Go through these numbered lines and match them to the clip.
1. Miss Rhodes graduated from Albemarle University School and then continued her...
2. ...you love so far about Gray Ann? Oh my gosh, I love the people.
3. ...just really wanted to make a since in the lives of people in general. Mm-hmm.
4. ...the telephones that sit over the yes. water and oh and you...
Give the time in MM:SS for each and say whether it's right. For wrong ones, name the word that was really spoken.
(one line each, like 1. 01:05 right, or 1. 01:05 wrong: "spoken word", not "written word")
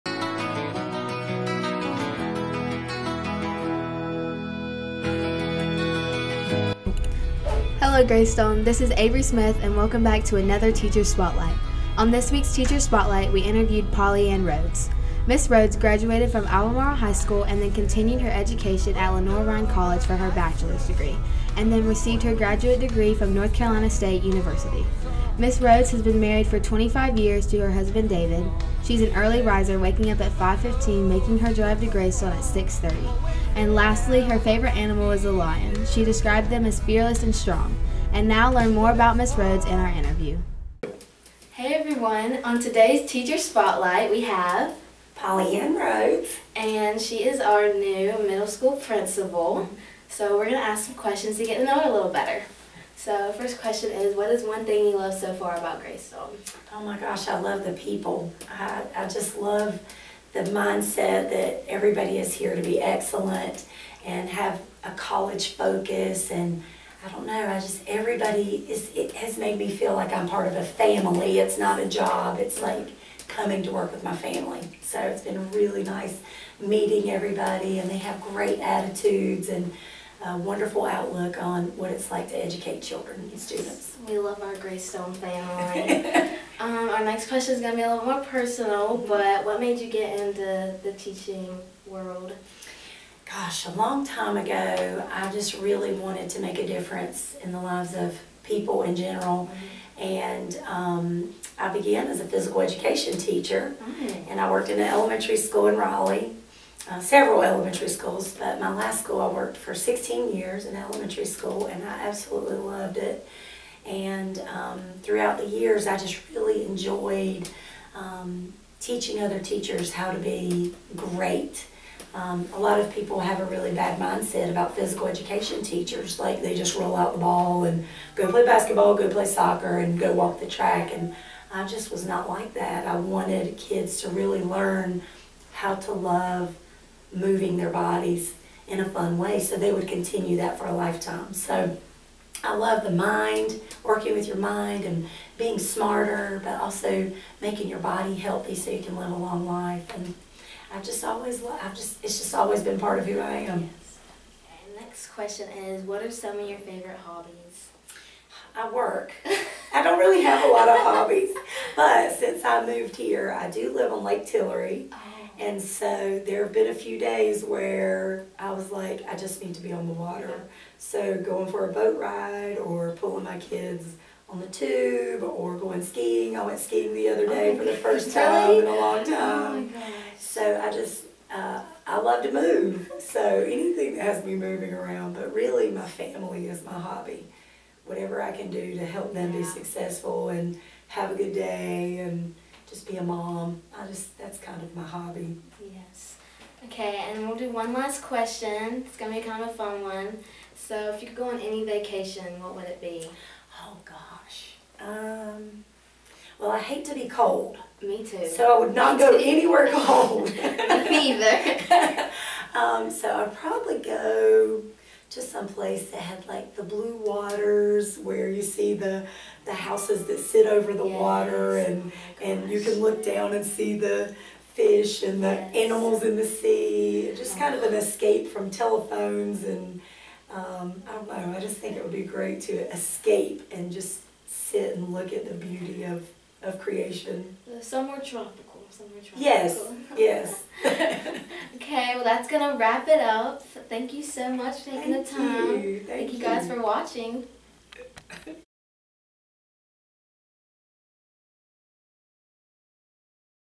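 1. 00:15 wrong: "High", not "University"
2. 00:54 wrong: "Stone", not "Ann"
3. 01:35 wrong: "difference", not "since"
4. 03:39 wrong: "houses", not "telephones".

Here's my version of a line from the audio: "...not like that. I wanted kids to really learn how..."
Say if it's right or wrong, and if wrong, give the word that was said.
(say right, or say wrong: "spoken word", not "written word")
right.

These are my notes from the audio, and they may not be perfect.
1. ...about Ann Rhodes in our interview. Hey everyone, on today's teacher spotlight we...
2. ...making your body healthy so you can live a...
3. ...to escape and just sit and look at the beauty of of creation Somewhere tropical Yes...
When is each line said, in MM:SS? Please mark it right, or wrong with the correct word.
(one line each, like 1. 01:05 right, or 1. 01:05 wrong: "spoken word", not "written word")
1. 00:38 wrong: "Miss", not "Ann"
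2. 02:27 right
3. 03:52 right.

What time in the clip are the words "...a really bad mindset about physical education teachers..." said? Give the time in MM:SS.
02:03.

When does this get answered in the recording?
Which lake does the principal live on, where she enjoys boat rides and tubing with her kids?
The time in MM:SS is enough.
02:44.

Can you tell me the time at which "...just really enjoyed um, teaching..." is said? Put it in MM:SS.
01:55.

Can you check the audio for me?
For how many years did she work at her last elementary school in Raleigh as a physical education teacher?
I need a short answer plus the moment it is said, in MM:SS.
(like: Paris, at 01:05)
16, at 01:49.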